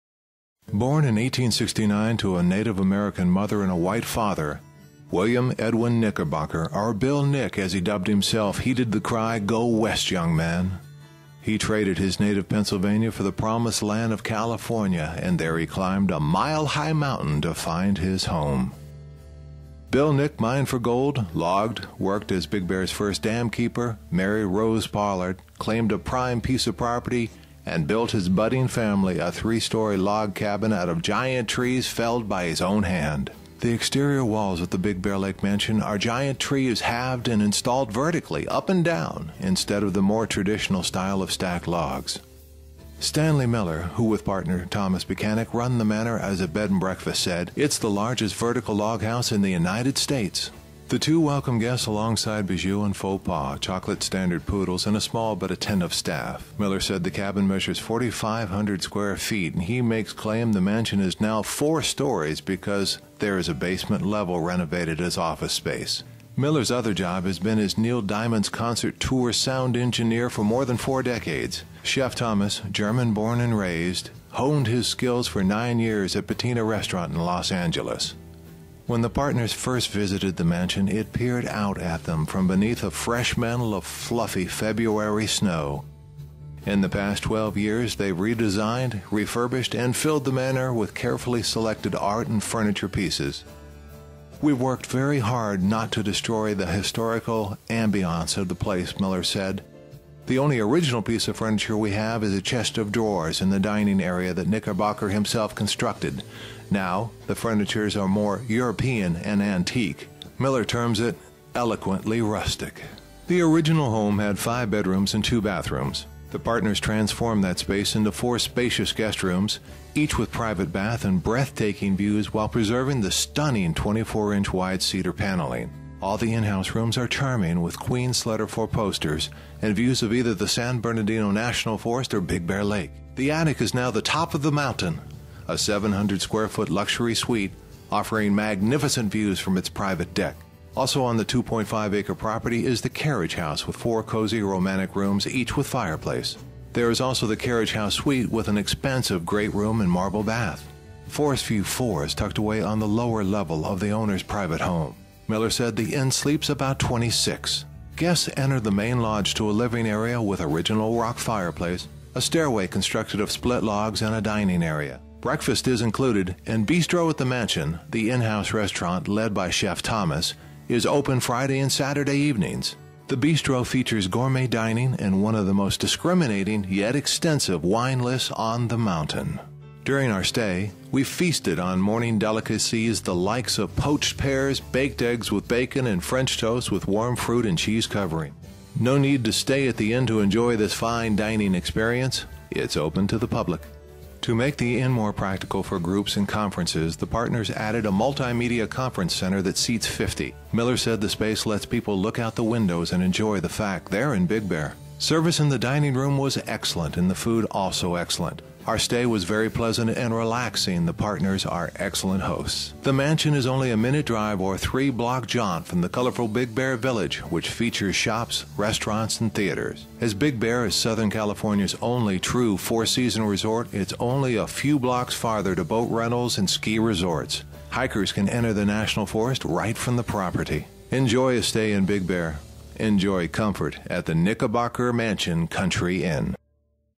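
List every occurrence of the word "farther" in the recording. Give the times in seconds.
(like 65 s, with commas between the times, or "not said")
225 s.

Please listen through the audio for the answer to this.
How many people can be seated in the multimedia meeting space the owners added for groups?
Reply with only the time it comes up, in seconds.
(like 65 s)
199 s.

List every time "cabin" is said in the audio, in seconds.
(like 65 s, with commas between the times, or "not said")
30 s, 57 s.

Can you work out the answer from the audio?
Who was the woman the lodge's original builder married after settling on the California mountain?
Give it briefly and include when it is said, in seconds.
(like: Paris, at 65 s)
Rose Pollard, at 24 s.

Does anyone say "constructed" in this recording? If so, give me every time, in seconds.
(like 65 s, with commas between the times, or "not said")
105 s, 162 s.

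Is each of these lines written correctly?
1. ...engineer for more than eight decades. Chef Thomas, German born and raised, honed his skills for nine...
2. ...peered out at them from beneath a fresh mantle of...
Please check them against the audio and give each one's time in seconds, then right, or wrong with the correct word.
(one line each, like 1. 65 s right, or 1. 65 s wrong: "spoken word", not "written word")
1. 69 s wrong: "four", not "eight"
2. 81 s right.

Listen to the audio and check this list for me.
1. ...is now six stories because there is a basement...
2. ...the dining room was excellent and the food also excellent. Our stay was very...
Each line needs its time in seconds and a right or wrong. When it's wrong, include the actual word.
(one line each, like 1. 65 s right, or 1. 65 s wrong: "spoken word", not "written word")
1. 60 s wrong: "four", not "six"
2. 205 s right.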